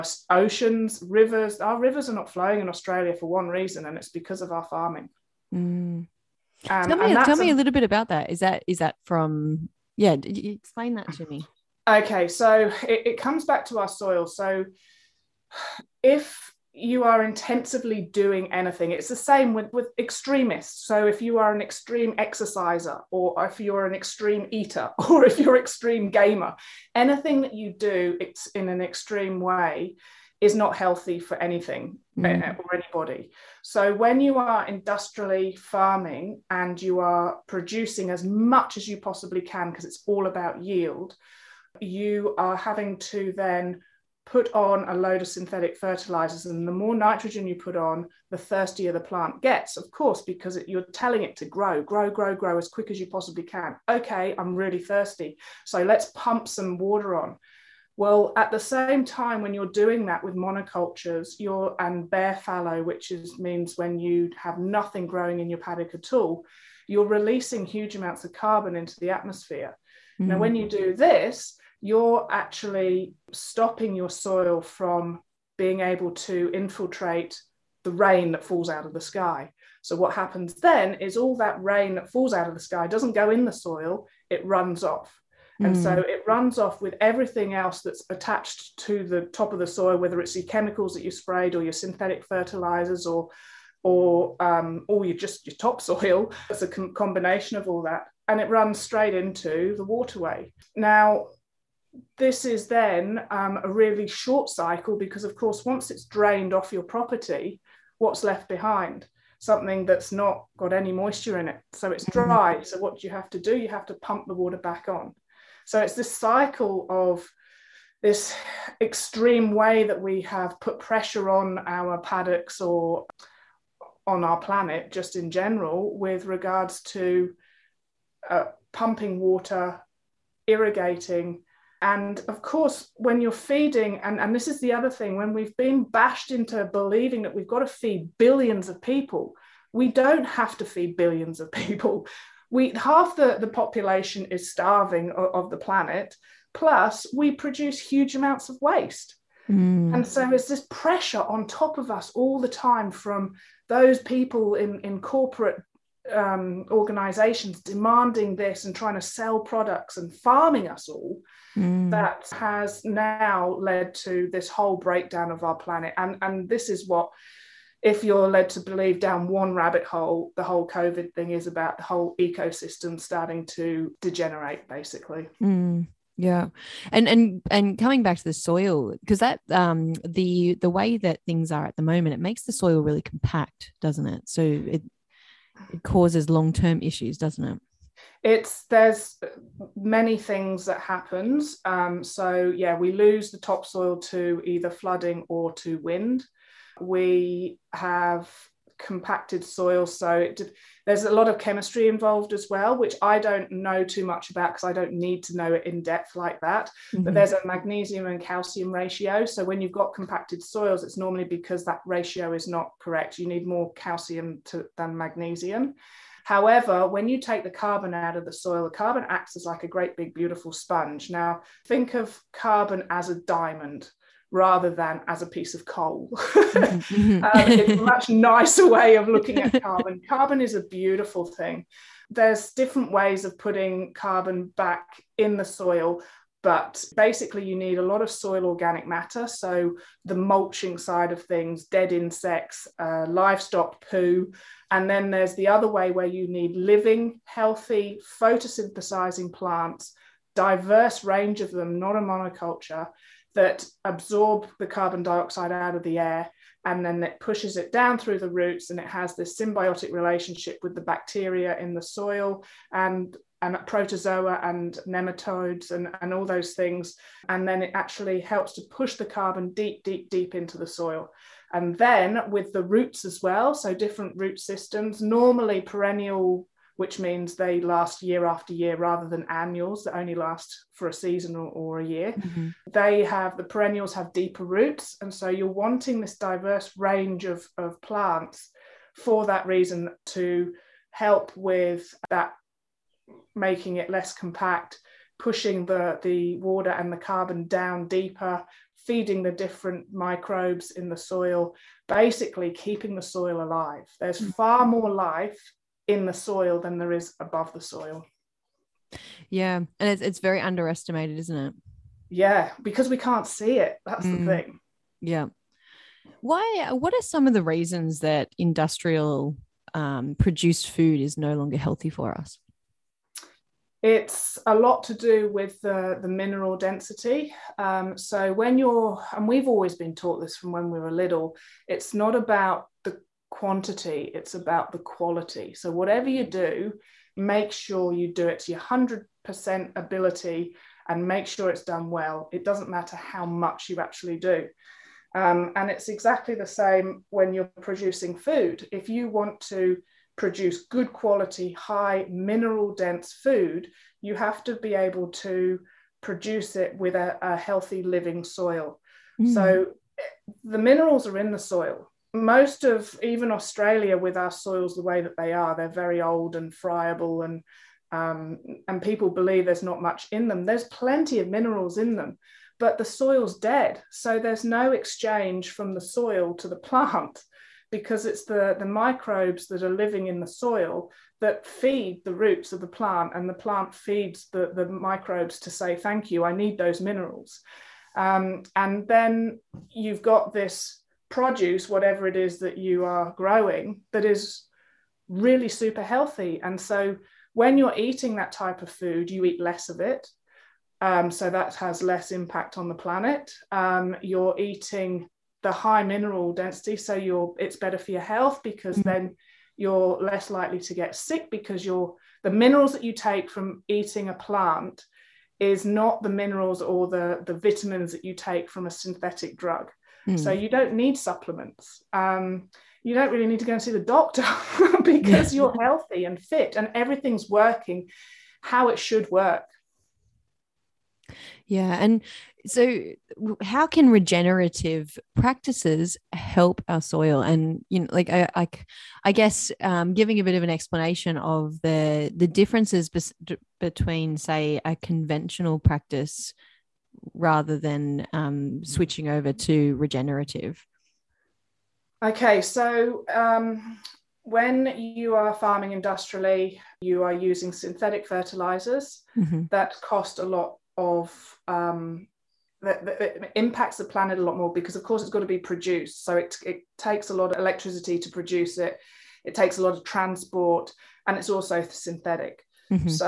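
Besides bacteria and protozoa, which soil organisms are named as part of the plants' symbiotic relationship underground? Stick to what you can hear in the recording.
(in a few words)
Nematodes.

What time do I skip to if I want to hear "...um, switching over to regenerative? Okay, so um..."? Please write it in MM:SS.
07:28.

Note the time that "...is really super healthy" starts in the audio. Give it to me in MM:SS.
06:34.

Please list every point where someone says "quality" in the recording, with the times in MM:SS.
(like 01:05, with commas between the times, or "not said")
05:34, 05:50.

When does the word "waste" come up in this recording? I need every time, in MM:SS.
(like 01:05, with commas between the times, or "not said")
02:28.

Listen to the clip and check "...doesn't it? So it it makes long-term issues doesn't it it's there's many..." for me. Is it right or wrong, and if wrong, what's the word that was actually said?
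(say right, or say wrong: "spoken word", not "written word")
wrong: "causes", not "makes".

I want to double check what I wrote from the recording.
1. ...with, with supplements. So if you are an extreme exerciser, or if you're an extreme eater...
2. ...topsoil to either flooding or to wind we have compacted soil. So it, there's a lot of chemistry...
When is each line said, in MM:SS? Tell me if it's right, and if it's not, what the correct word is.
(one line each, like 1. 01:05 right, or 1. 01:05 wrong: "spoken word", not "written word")
1. 00:19 wrong: "extremists", not "supplements"
2. 03:13 right.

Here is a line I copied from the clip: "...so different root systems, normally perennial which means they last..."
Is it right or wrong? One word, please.
right.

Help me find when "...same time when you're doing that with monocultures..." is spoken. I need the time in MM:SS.
00:58.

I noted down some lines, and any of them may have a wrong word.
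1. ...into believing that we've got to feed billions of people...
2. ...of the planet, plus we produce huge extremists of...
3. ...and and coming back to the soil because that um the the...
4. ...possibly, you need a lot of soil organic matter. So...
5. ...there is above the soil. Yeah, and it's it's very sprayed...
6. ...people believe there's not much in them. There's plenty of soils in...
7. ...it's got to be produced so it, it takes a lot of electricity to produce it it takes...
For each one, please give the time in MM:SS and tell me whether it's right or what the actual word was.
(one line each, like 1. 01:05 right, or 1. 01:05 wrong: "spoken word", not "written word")
1. 02:16 right
2. 02:25 wrong: "amounts", not "extremists"
3. 02:57 right
4. 03:56 wrong: "basically", not "possibly"
5. 05:06 wrong: "underestimated", not "sprayed"
6. 06:08 wrong: "minerals", not "soils"
7. 07:45 right.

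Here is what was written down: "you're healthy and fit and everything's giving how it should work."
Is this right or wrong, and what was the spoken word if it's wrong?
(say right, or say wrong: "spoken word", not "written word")
wrong: "working", not "giving".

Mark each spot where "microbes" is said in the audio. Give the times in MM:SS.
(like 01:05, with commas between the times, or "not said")
04:59, 06:18, 06:24.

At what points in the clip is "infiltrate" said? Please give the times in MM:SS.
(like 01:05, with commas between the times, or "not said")
01:16.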